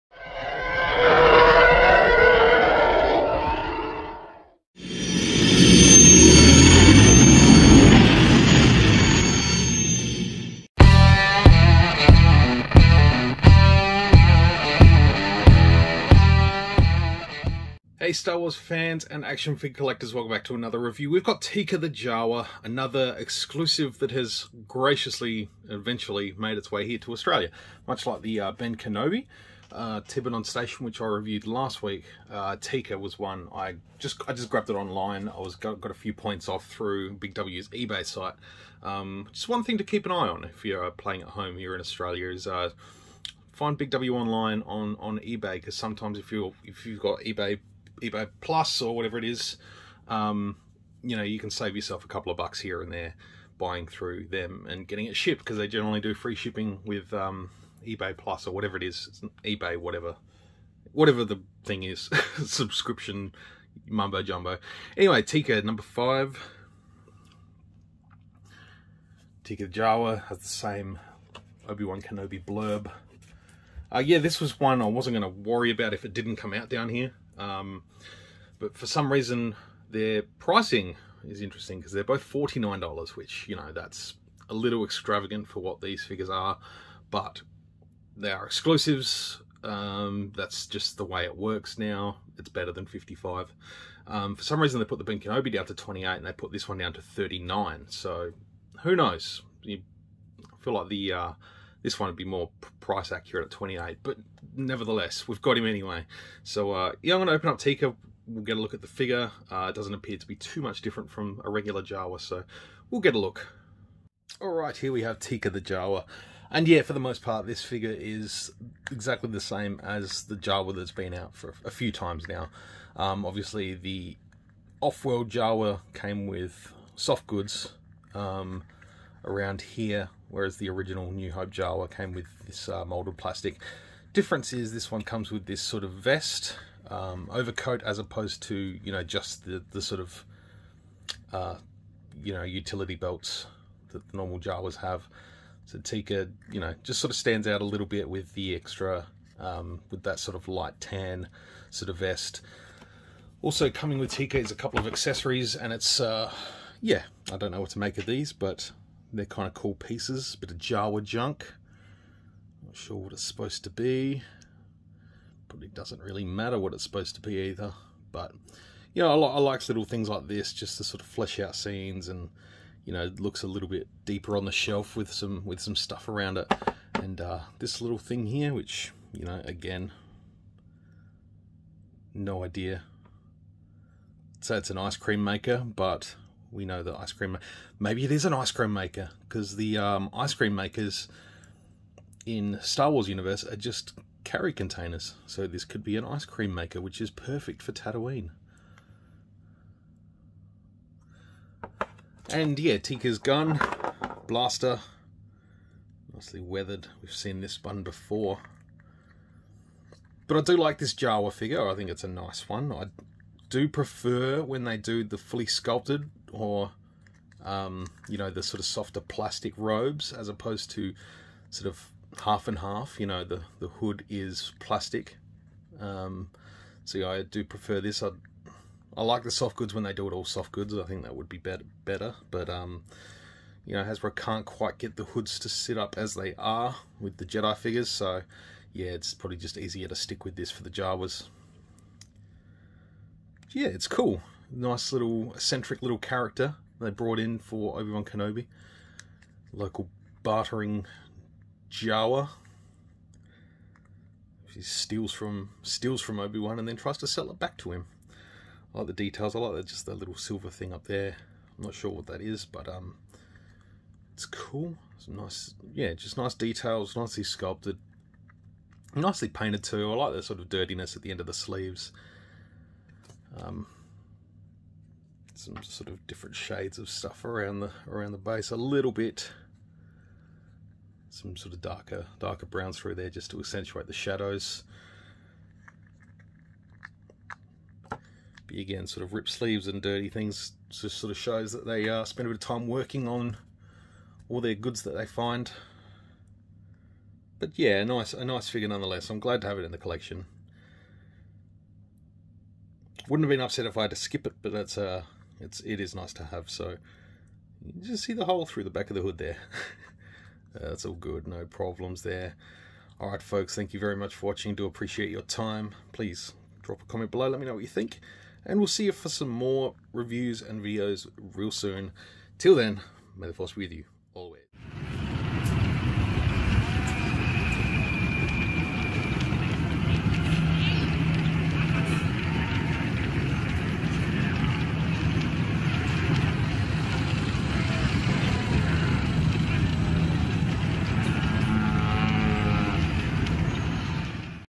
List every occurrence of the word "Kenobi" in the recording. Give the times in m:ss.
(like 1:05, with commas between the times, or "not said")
0:28, 1:12, 1:35, 4:08.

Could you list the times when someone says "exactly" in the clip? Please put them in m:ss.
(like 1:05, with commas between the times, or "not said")
1:58.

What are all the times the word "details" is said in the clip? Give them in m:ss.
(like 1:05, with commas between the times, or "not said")
4:18, 4:26.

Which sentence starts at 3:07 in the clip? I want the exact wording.
Maybe it is an ice cream maker because the um, ice cream makers in Star Wars universe are just carry containers.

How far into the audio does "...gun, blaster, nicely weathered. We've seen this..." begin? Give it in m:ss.
3:23.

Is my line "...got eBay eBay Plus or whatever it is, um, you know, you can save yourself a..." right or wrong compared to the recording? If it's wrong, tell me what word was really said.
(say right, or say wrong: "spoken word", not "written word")
right.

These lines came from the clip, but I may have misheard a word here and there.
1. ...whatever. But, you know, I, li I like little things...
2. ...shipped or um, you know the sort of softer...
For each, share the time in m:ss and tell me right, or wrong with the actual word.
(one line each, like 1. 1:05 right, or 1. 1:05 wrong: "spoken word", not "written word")
1. 2:47 wrong: "either", not "whatever"
2. 3:35 wrong: "sculpted", not "shipped".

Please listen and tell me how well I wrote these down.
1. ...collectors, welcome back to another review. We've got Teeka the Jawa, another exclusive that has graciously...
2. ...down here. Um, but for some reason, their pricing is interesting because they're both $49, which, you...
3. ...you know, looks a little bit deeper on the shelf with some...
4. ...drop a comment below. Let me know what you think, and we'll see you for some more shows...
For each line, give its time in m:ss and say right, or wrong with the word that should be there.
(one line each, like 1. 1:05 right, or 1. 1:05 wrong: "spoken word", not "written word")
1. 0:19 right
2. 1:16 right
3. 2:52 right
4. 5:16 wrong: "reviews", not "shows".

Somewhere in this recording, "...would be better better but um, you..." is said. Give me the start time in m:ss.
3:51.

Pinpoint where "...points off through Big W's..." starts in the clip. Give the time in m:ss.
0:36.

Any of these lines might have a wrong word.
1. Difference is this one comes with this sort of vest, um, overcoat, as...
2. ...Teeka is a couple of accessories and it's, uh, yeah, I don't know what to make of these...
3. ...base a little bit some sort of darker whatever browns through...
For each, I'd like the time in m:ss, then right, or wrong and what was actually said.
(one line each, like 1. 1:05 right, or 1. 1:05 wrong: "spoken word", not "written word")
1. 2:14 right
2. 2:34 right
3. 4:38 wrong: "darker", not "whatever".